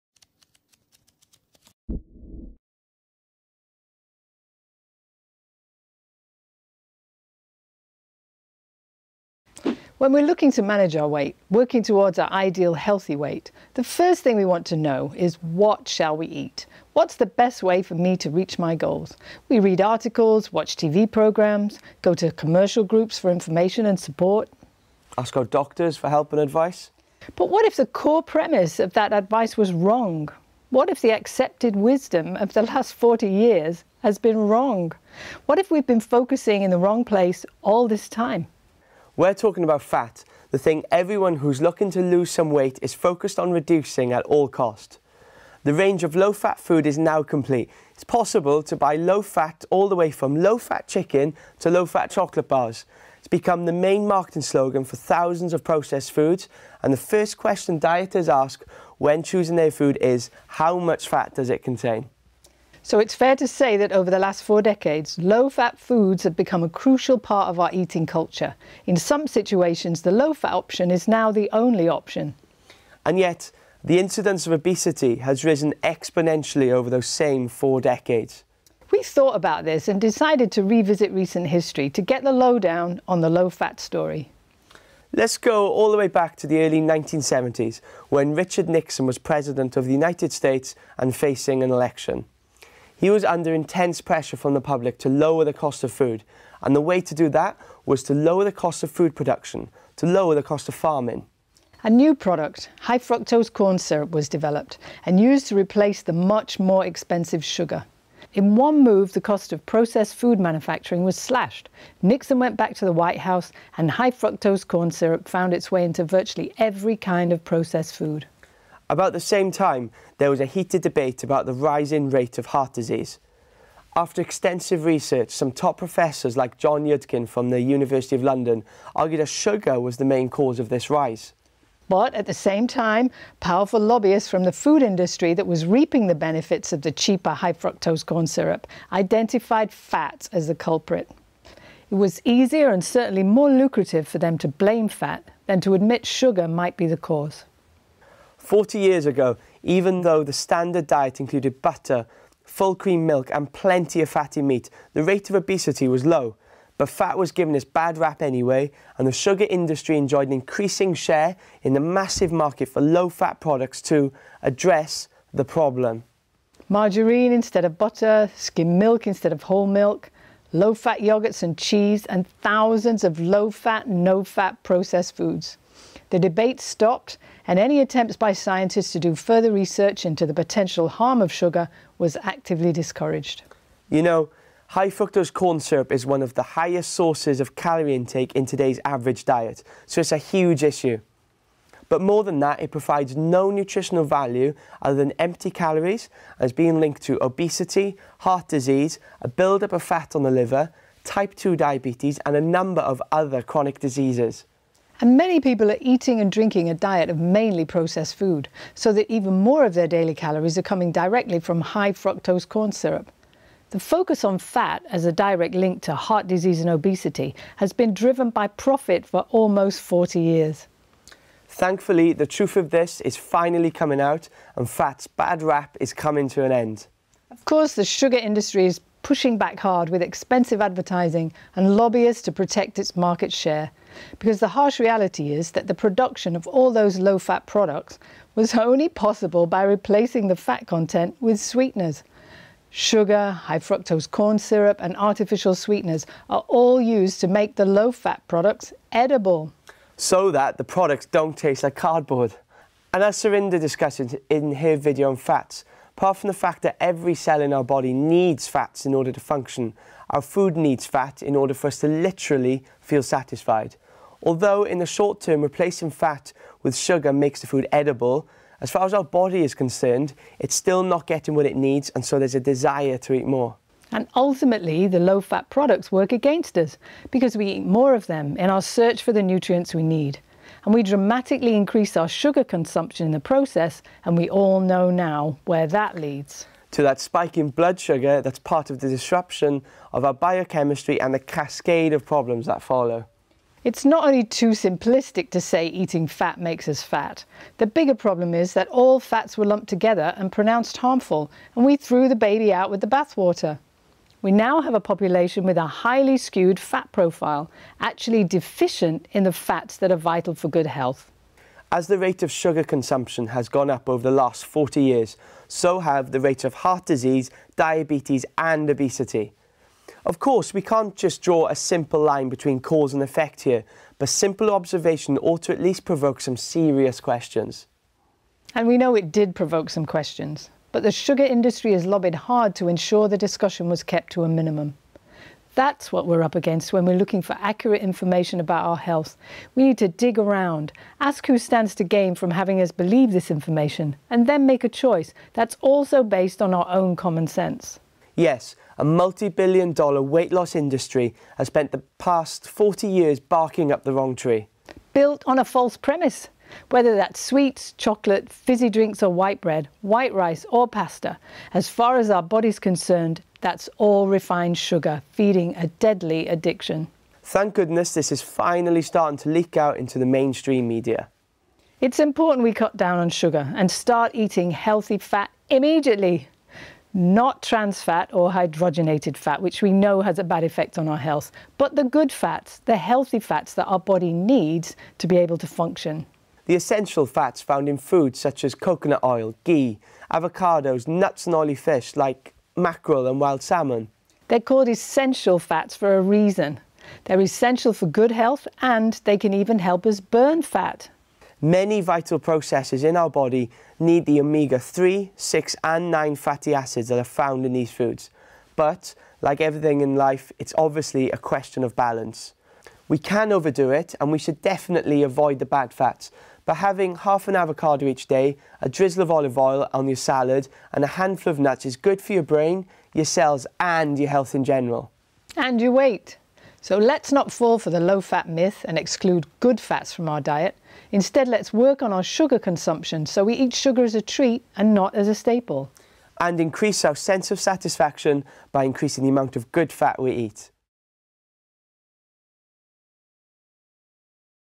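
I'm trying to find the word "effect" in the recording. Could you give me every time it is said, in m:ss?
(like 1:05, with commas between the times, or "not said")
5:23, 6:20.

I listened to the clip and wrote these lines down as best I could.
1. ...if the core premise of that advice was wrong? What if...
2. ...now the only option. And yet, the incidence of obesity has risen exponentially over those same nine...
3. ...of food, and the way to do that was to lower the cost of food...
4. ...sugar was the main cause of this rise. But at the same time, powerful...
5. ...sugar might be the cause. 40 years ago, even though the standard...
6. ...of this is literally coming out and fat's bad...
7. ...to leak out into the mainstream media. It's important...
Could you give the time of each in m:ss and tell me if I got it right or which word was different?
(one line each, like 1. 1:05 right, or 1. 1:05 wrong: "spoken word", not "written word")
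1. 0:27 right
2. 1:11 wrong: "four", not "nine"
3. 1:35 right
4. 2:09 right
5. 2:26 right
6. 3:42 wrong: "finally", not "literally"
7. 6:09 right.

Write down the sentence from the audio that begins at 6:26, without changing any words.
The essential fats found in foods such as coconut oil, ghee, avocados, nuts and oily fish like mackerel and wild salmon.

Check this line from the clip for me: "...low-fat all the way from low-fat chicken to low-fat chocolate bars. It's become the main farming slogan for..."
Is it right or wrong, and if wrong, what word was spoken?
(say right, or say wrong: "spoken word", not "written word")
wrong: "marketing", not "farming".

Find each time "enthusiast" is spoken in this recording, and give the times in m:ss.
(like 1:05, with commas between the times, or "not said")
not said.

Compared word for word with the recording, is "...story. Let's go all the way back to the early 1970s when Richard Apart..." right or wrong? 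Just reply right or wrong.
wrong.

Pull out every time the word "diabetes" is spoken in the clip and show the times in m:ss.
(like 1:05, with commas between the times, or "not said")
3:21, 5:17.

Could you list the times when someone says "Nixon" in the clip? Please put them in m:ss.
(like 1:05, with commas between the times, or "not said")
1:28, 1:52.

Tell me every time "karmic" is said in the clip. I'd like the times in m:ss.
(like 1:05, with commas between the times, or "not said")
not said.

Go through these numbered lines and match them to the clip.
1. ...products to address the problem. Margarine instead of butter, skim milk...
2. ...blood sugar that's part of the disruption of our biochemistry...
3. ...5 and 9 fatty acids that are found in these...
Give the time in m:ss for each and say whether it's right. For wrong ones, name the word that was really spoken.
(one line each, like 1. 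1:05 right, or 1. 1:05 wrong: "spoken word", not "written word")
1. 2:43 right
2. 4:47 right
3. 6:45 wrong: "6", not "5".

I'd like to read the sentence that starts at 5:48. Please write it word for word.
Yes, a multi billion dollar weight loss industry has spent the past 40 years barking up the wrong tree.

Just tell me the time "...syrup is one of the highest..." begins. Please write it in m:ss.
3:05.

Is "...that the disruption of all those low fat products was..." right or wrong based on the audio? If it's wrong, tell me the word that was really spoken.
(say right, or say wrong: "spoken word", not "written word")
wrong: "production", not "disruption".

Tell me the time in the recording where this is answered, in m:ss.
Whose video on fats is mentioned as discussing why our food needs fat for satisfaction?
4:13.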